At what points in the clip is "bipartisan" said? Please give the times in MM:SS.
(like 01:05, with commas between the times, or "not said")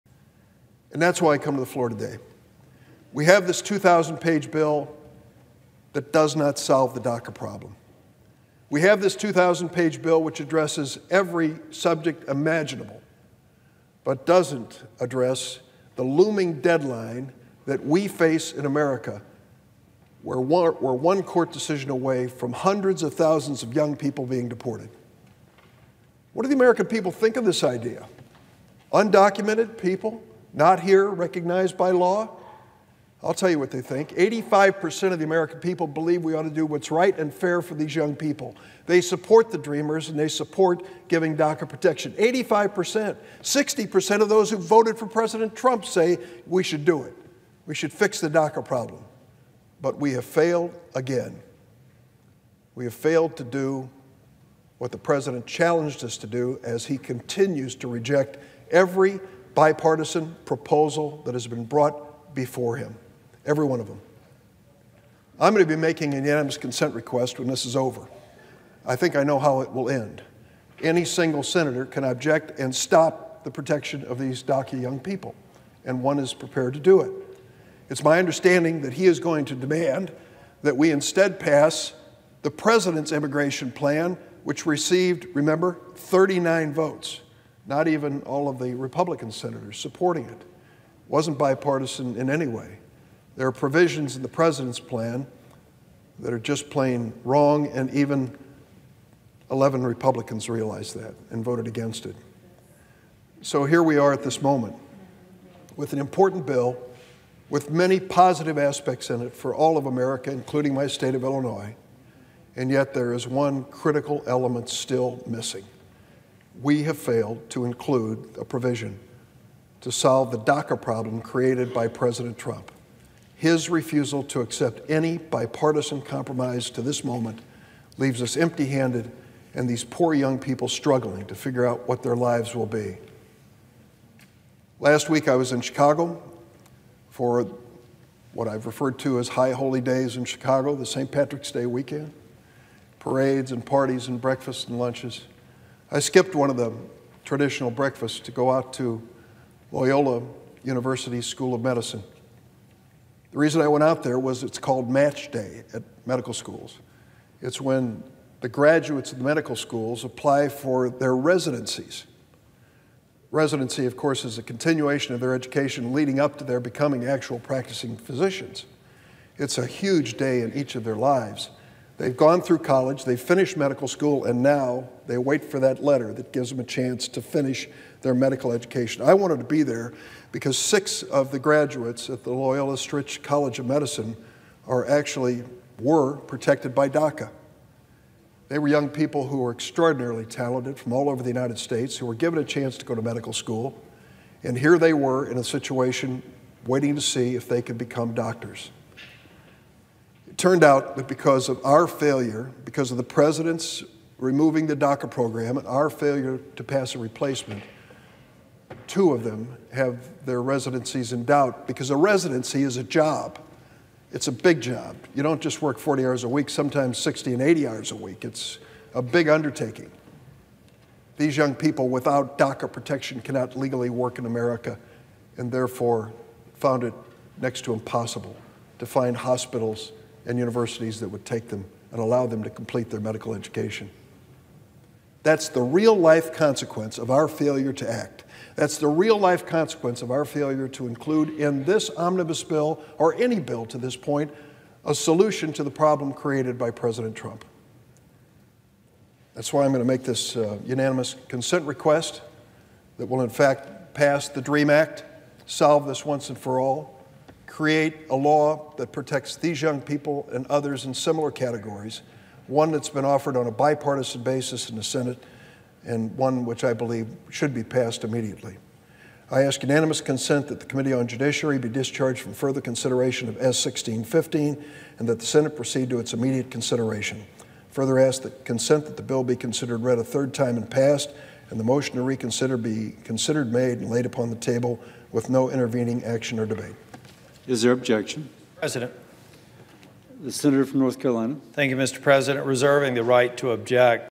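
00:59, 01:31, 02:05, 04:23.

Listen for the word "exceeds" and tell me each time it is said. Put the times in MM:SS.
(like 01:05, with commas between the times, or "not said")
not said.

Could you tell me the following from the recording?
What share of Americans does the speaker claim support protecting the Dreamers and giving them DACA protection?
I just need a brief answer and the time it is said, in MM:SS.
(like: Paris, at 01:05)
85%, at 00:34.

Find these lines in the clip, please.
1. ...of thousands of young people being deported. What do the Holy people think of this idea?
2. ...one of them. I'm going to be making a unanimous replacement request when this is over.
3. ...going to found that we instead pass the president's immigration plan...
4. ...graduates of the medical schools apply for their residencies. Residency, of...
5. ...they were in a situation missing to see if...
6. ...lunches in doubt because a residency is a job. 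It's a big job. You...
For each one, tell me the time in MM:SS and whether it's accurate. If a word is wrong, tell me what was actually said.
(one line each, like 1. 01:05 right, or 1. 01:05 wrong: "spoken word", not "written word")
1. 00:23 wrong: "American", not "Holy"
2. 01:03 wrong: "consent", not "replacement"
3. 01:19 wrong: "demand", not "found"
4. 02:38 right
5. 03:14 wrong: "waiting", not "missing"
6. 03:30 wrong: "residencies", not "lunches".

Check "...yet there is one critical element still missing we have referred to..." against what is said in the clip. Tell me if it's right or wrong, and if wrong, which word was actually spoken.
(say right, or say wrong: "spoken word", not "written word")
wrong: "failed", not "referred".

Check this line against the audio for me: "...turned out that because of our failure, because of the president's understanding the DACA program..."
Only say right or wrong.
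wrong.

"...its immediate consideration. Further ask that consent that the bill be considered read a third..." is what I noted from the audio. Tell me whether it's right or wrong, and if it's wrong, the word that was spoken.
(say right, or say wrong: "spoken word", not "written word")
right.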